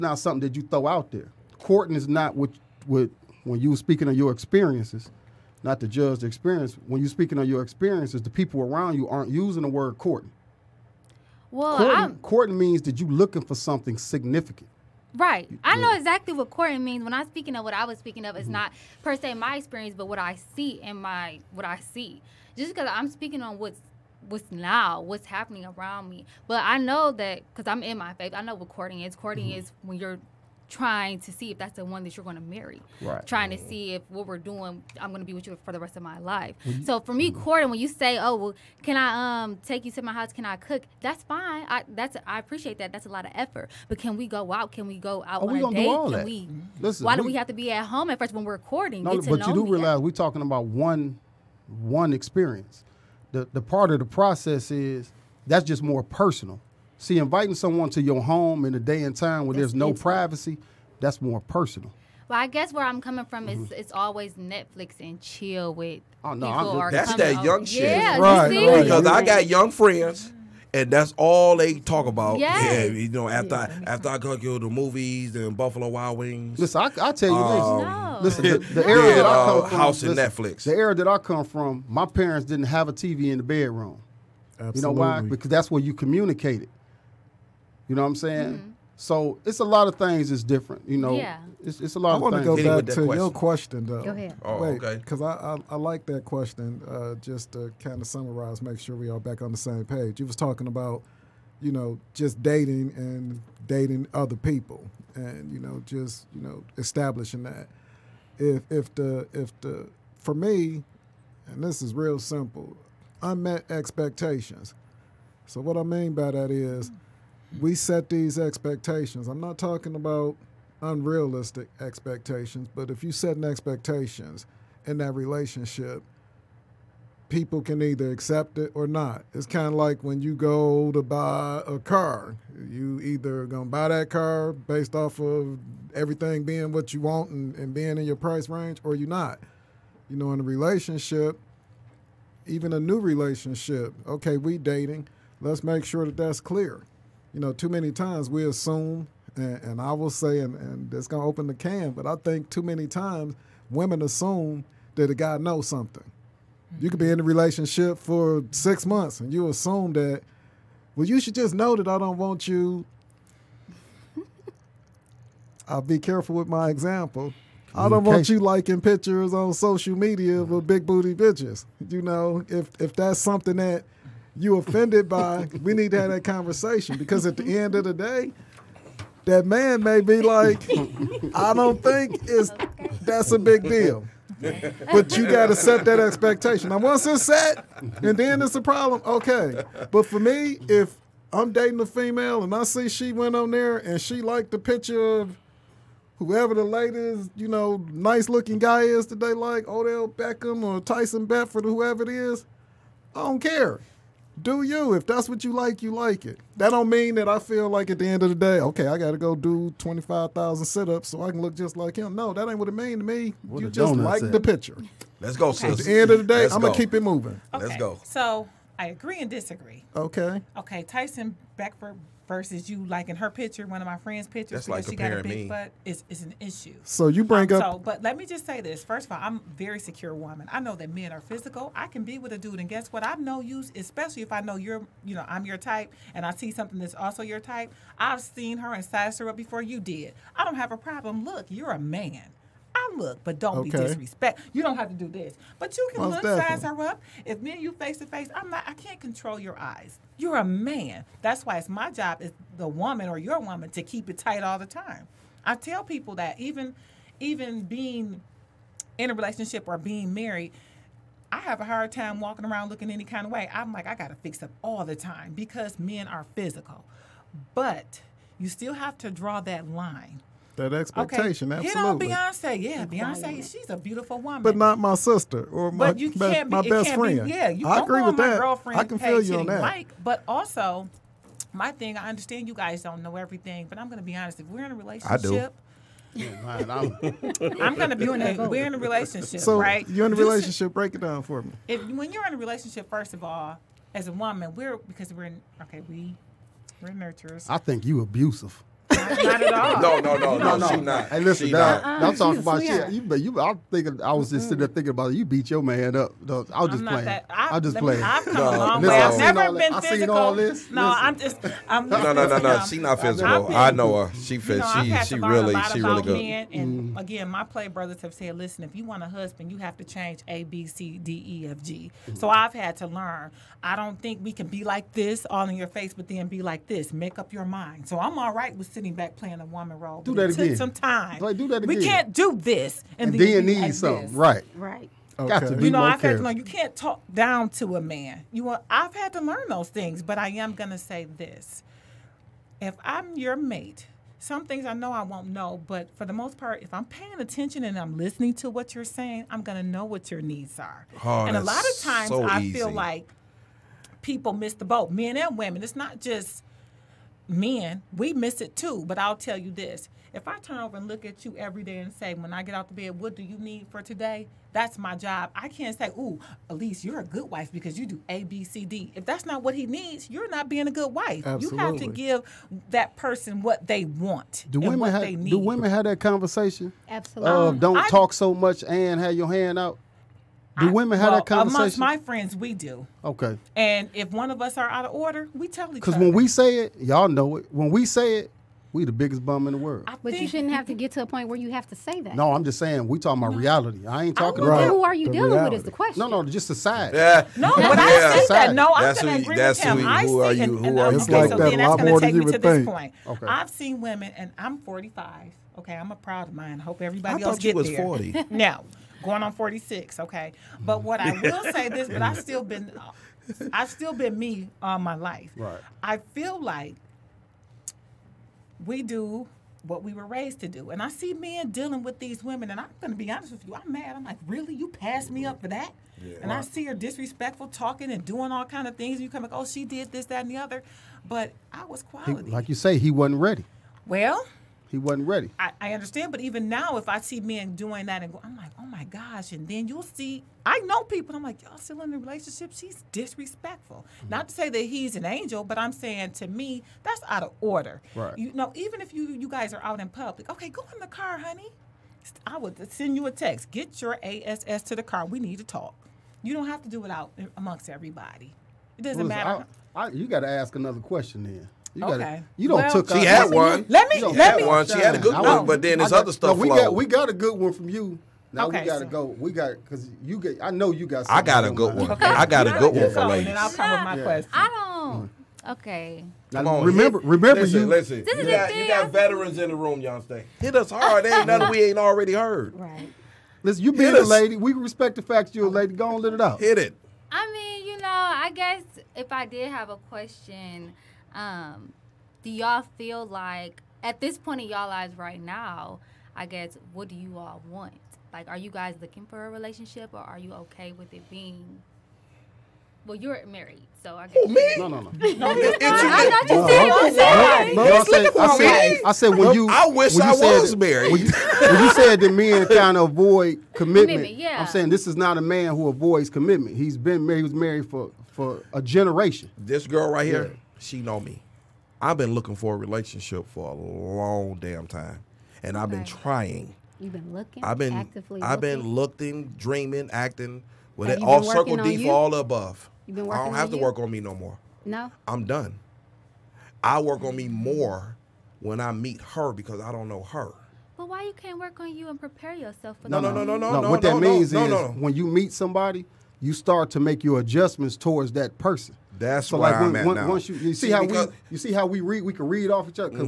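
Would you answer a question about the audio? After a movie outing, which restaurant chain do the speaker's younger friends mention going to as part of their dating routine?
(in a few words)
Buffalo Wild Wings.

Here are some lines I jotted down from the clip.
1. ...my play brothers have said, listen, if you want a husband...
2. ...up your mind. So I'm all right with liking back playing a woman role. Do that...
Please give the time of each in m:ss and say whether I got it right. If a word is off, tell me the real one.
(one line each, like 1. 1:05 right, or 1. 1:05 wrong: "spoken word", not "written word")
1. 5:17 right
2. 5:27 wrong: "sitting", not "liking".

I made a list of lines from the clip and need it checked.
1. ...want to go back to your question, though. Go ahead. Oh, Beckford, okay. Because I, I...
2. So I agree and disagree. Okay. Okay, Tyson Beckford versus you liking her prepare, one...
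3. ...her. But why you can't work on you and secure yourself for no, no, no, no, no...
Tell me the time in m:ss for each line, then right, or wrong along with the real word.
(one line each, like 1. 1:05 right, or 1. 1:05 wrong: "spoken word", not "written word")
1. 1:32 wrong: "Wait", not "Beckford"
2. 3:38 wrong: "picture", not "prepare"
3. 9:00 wrong: "prepare", not "secure".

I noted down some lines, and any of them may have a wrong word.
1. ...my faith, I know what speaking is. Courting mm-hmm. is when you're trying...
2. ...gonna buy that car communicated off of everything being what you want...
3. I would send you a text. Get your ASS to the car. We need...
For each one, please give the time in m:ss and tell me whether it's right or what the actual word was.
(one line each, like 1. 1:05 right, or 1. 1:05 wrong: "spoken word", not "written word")
1. 0:27 wrong: "courting", not "speaking"
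2. 2:13 wrong: "based", not "communicated"
3. 7:32 right.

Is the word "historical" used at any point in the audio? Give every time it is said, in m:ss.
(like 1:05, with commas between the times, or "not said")
not said.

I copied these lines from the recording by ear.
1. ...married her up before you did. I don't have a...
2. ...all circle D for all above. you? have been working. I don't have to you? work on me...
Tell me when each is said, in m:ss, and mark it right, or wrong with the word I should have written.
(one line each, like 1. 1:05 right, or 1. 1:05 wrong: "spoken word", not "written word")
1. 3:58 wrong: "sized", not "married"
2. 8:51 right.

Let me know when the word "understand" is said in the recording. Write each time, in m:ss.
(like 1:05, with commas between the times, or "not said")
4:42, 7:15.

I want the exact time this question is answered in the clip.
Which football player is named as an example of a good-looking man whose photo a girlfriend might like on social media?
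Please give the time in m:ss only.
3:19.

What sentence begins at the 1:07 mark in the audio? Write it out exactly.
Yeah, right, Because I got young friends.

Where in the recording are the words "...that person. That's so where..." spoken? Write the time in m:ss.
9:08.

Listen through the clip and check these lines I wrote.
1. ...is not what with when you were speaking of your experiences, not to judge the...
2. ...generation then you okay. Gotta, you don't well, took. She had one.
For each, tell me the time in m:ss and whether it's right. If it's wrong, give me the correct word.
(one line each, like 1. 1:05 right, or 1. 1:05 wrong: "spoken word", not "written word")
1. 0:01 right
2. 7:40 wrong: "question", not "generation".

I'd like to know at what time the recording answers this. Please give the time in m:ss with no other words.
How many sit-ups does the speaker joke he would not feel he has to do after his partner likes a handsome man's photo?
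3:29.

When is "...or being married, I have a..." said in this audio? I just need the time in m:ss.
4:19.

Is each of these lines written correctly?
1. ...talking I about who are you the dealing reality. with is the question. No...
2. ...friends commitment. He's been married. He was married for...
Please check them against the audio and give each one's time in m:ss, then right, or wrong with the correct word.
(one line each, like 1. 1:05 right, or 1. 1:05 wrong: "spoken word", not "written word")
1. 6:34 right
2. 8:35 wrong: "avoids", not "friends".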